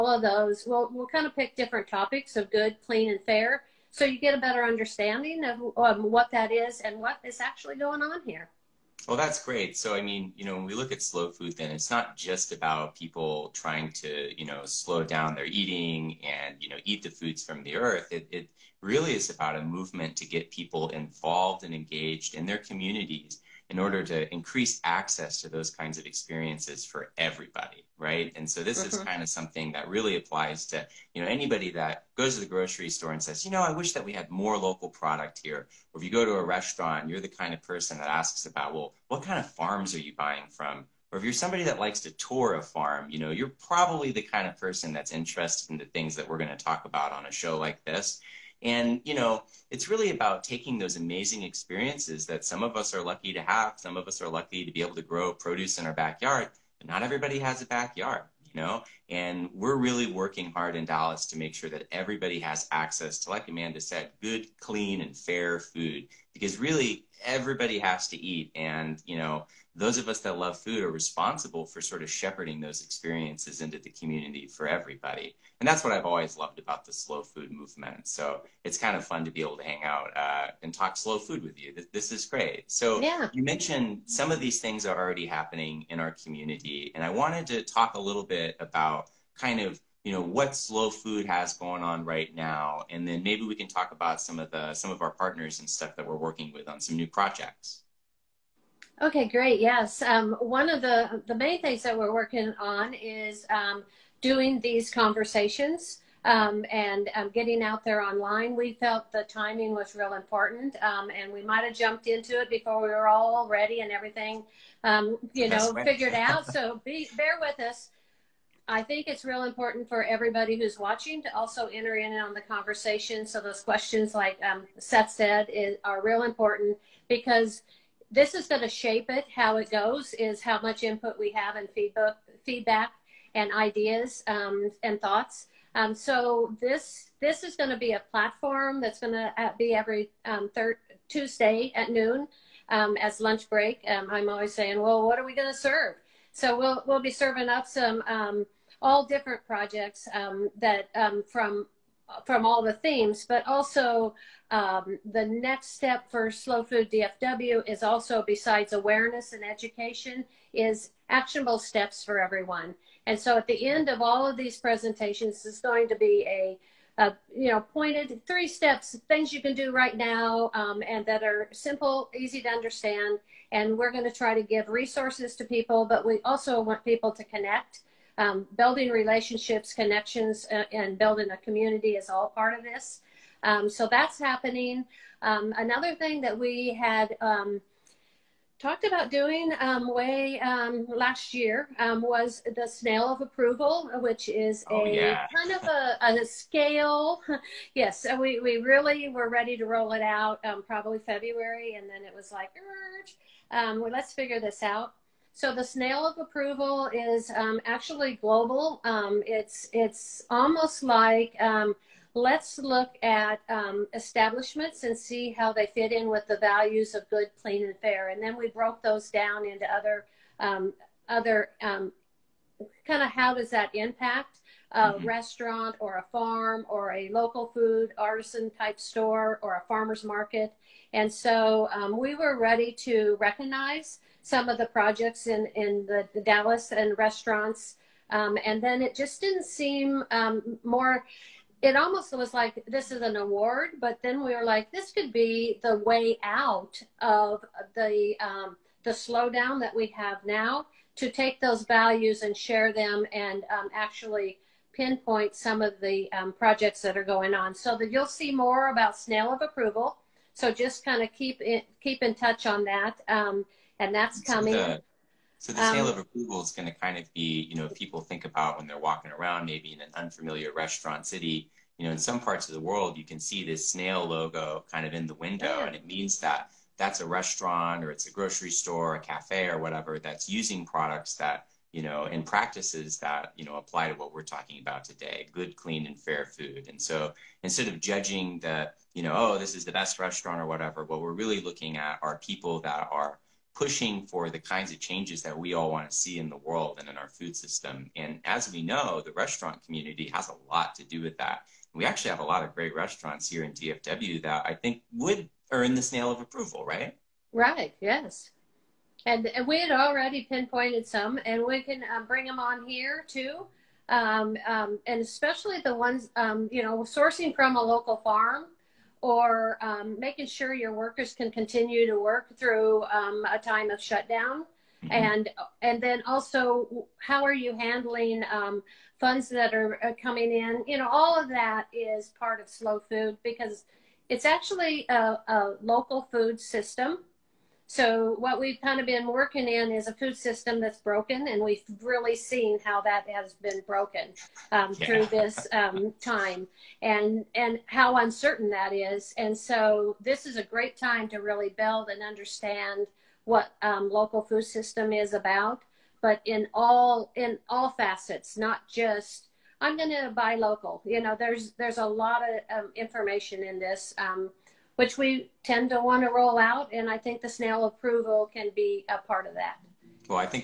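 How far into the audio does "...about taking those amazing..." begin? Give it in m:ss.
0:50.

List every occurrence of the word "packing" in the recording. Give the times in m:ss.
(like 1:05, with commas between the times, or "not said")
not said.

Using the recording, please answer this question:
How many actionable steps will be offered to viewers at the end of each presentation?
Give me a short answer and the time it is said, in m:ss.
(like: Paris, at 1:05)
3, at 2:48.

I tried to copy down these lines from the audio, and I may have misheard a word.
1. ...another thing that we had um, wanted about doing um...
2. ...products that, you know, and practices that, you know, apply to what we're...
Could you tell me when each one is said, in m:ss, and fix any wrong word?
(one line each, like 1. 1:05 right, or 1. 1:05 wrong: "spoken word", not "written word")
1. 3:05 wrong: "talked", not "wanted"
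2. 4:40 right.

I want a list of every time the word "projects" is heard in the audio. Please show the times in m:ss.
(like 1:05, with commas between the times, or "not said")
1:37, 2:29, 3:54, 4:16.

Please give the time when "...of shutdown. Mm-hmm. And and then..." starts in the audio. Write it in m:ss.
5:23.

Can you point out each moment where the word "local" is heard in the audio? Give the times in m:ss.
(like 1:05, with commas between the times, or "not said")
0:34, 3:47, 5:17, 5:35, 5:53, 6:00.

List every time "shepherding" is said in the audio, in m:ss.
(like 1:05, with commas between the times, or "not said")
1:12.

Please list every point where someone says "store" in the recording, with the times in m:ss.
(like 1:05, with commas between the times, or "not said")
0:32, 3:48, 4:38.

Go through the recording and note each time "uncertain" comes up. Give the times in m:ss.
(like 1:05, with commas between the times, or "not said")
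5:47.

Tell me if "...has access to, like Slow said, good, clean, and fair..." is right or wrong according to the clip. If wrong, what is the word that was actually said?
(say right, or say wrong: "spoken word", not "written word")
wrong: "Amanda", not "Slow".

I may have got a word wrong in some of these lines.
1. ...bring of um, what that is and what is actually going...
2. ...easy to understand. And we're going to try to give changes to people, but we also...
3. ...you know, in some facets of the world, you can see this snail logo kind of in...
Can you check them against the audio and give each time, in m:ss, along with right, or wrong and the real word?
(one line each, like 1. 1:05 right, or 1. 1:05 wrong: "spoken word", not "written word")
1. 0:04 wrong: "understanding", not "bring"
2. 2:52 wrong: "resources", not "changes"
3. 4:31 wrong: "parts", not "facets".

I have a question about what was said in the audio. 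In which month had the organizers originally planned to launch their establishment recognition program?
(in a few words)
February.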